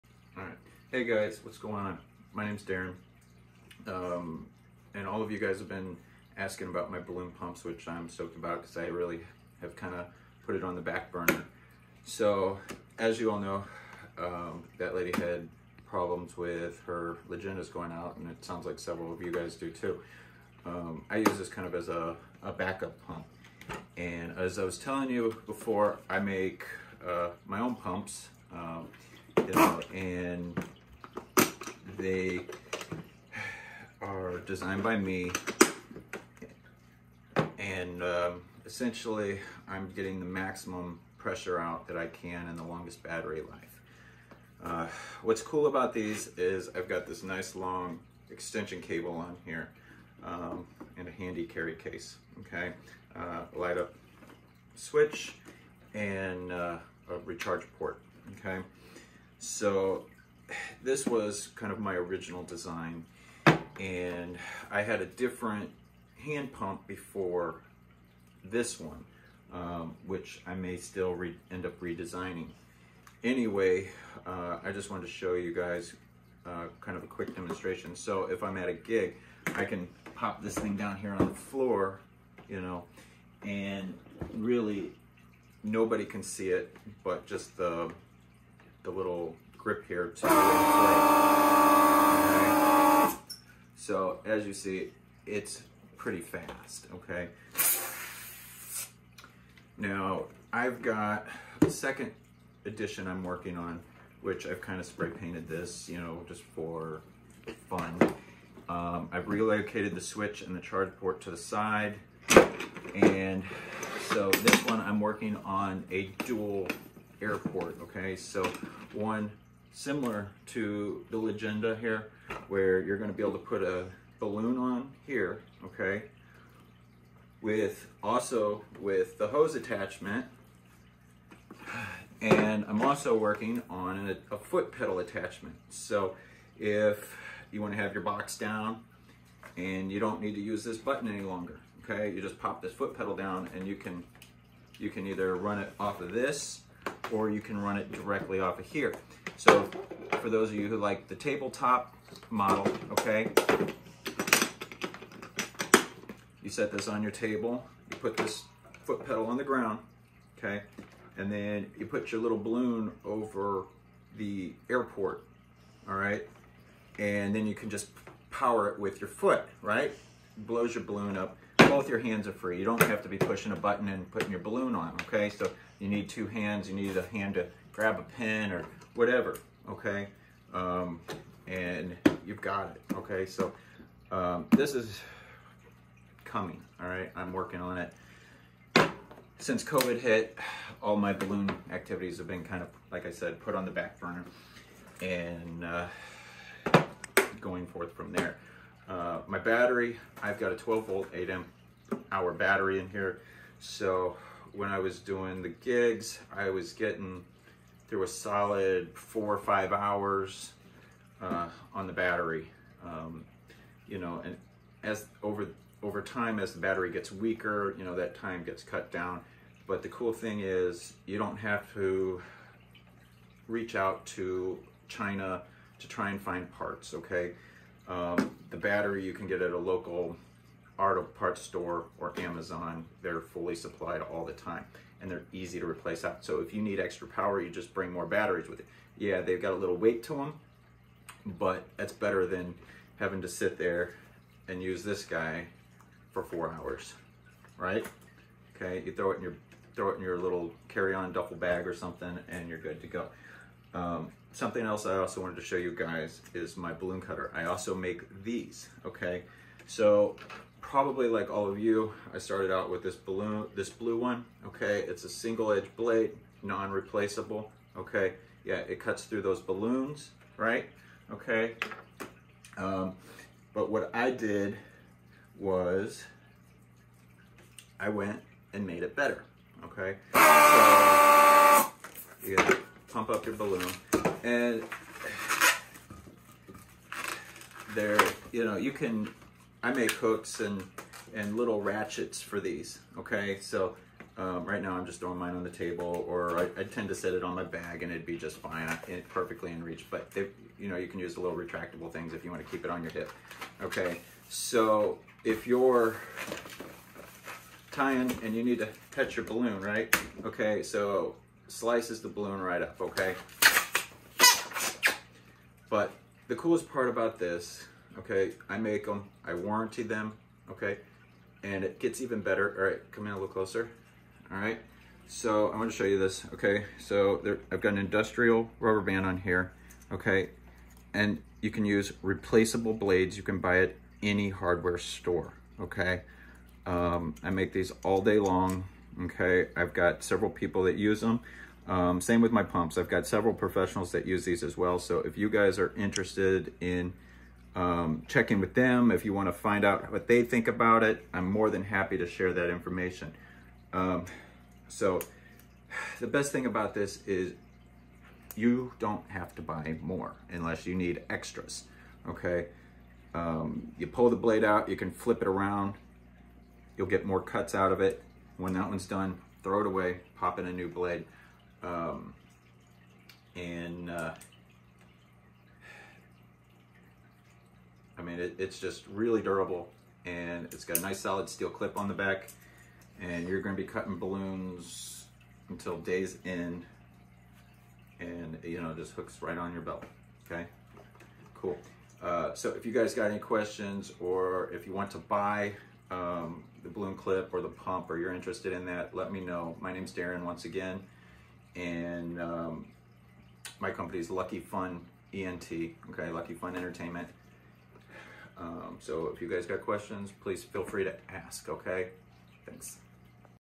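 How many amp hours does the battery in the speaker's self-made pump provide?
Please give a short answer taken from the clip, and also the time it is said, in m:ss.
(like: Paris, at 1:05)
8 amp hour, at 3:21.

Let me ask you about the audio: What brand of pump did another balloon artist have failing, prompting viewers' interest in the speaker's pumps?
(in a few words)
Legenda.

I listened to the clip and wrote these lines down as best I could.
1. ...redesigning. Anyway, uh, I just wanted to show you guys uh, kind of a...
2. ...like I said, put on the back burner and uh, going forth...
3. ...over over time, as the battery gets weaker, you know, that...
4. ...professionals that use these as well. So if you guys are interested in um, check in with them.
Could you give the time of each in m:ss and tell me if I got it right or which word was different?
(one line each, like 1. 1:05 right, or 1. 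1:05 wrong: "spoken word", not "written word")
1. 1:11 right
2. 3:12 right
3. 3:35 right
4. 5:43 right.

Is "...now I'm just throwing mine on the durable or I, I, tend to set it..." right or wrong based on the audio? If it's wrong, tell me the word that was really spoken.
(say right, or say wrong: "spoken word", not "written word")
wrong: "table", not "durable".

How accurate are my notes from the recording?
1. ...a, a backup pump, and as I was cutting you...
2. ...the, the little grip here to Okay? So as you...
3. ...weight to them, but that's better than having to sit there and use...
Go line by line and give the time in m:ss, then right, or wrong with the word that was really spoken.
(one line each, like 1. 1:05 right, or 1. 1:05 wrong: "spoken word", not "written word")
1. 0:21 wrong: "telling", not "cutting"
2. 1:27 right
3. 3:59 right.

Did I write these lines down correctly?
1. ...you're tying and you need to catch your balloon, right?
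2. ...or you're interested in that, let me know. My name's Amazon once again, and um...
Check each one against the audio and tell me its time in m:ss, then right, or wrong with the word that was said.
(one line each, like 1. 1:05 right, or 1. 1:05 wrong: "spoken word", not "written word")
1. 5:05 right
2. 6:37 wrong: "Darren", not "Amazon".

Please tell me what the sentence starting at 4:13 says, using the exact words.
Um, something else I also wanted to show you guys is my balloon cutter.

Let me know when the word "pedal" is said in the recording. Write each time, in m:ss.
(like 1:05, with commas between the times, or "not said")
2:14, 2:22, 2:39.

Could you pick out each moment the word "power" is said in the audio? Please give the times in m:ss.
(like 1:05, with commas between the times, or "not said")
2:48, 3:57.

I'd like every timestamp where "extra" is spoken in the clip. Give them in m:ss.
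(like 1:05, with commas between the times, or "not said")
3:56, 6:01.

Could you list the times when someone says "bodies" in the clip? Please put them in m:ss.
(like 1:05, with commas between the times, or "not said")
not said.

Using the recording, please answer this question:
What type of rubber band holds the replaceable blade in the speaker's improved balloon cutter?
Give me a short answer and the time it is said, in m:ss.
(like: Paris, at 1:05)
industrial, at 5:27.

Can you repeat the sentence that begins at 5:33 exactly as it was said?
You can buy at any hardware store, okay?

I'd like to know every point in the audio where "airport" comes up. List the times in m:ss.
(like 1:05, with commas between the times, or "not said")
1:57, 2:44.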